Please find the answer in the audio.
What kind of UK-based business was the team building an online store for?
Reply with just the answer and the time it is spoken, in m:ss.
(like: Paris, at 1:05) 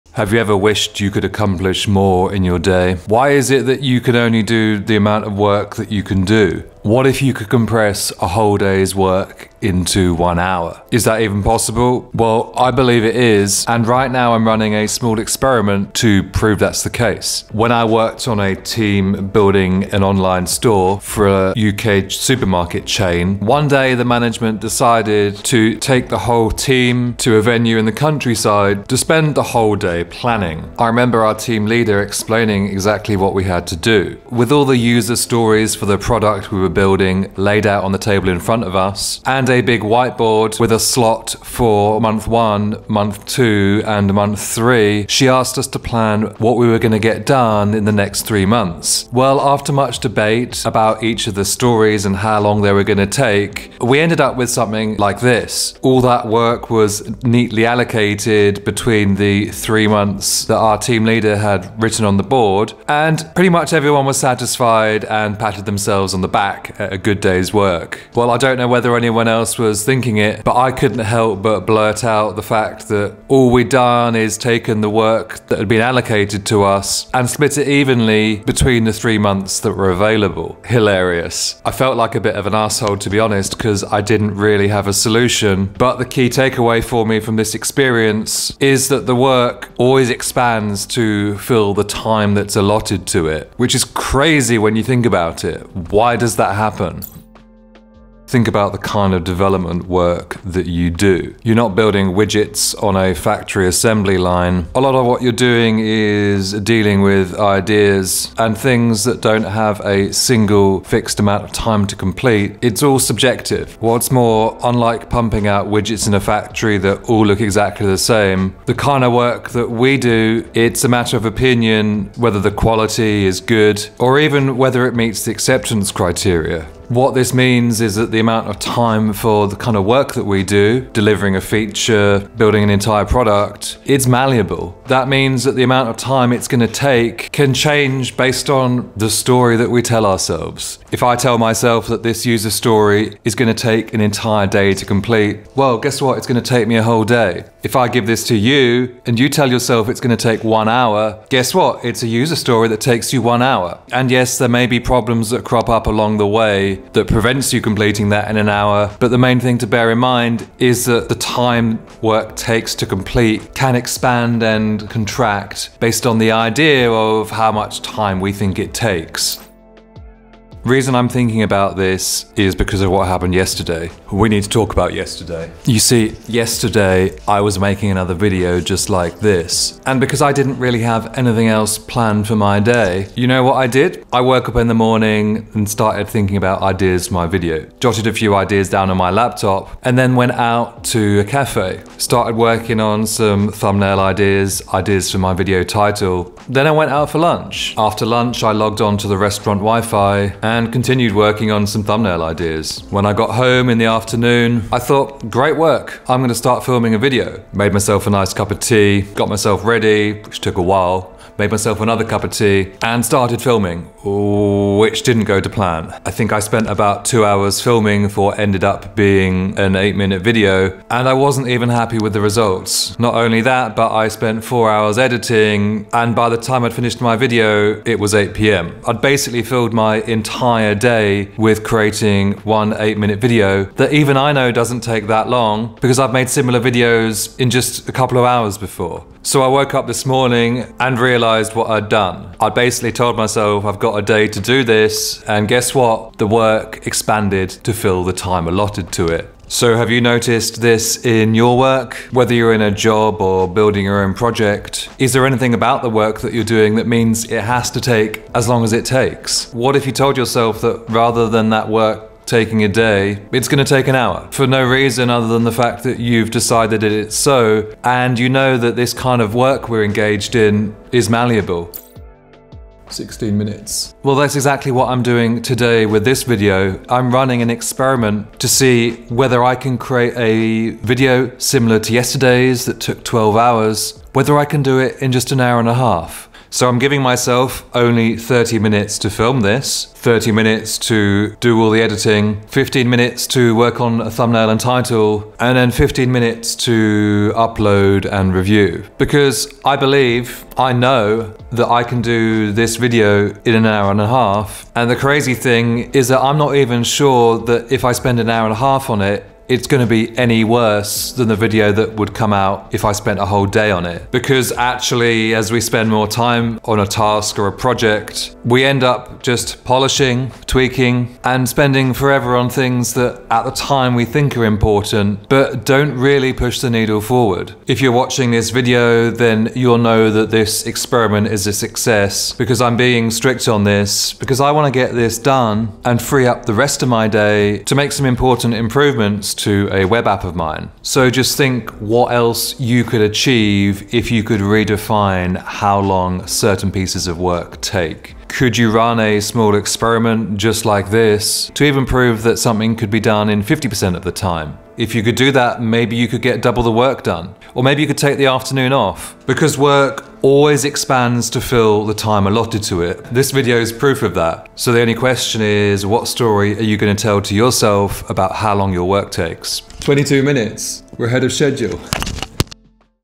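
supermarket chain, at 0:21.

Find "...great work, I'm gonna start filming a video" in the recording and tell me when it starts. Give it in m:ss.
3:25.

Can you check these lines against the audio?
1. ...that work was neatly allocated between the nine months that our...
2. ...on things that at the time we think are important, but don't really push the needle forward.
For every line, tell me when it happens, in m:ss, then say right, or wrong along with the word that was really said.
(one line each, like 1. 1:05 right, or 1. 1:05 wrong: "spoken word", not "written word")
1. 0:56 wrong: "three", not "nine"
2. 5:22 right.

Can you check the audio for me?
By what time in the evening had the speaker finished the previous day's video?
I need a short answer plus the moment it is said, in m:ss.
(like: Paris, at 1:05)
8 p.m., at 3:48.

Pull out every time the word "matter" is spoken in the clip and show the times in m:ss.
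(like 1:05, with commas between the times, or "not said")
2:00.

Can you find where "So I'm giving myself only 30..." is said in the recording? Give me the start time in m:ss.
4:46.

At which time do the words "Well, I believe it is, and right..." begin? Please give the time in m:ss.
0:12.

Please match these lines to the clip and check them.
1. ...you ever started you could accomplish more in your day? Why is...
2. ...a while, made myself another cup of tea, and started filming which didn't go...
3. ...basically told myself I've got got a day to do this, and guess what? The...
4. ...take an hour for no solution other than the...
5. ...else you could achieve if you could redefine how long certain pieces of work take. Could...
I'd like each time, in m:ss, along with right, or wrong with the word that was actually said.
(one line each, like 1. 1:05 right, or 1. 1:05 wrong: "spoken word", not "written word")
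1. 0:00 wrong: "wished", not "started"
2. 3:30 right
3. 4:02 right
4. 4:23 wrong: "reason", not "solution"
5. 5:42 right.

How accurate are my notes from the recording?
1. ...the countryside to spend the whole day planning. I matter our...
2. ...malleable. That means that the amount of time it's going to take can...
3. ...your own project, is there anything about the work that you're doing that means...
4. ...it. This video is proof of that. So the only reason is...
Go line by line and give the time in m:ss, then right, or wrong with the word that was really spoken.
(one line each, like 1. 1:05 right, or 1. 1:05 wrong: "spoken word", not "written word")
1. 0:27 wrong: "remember", not "matter"
2. 2:14 right
3. 4:13 right
4. 6:02 wrong: "question", not "reason".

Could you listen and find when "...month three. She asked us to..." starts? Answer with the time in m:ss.
0:44.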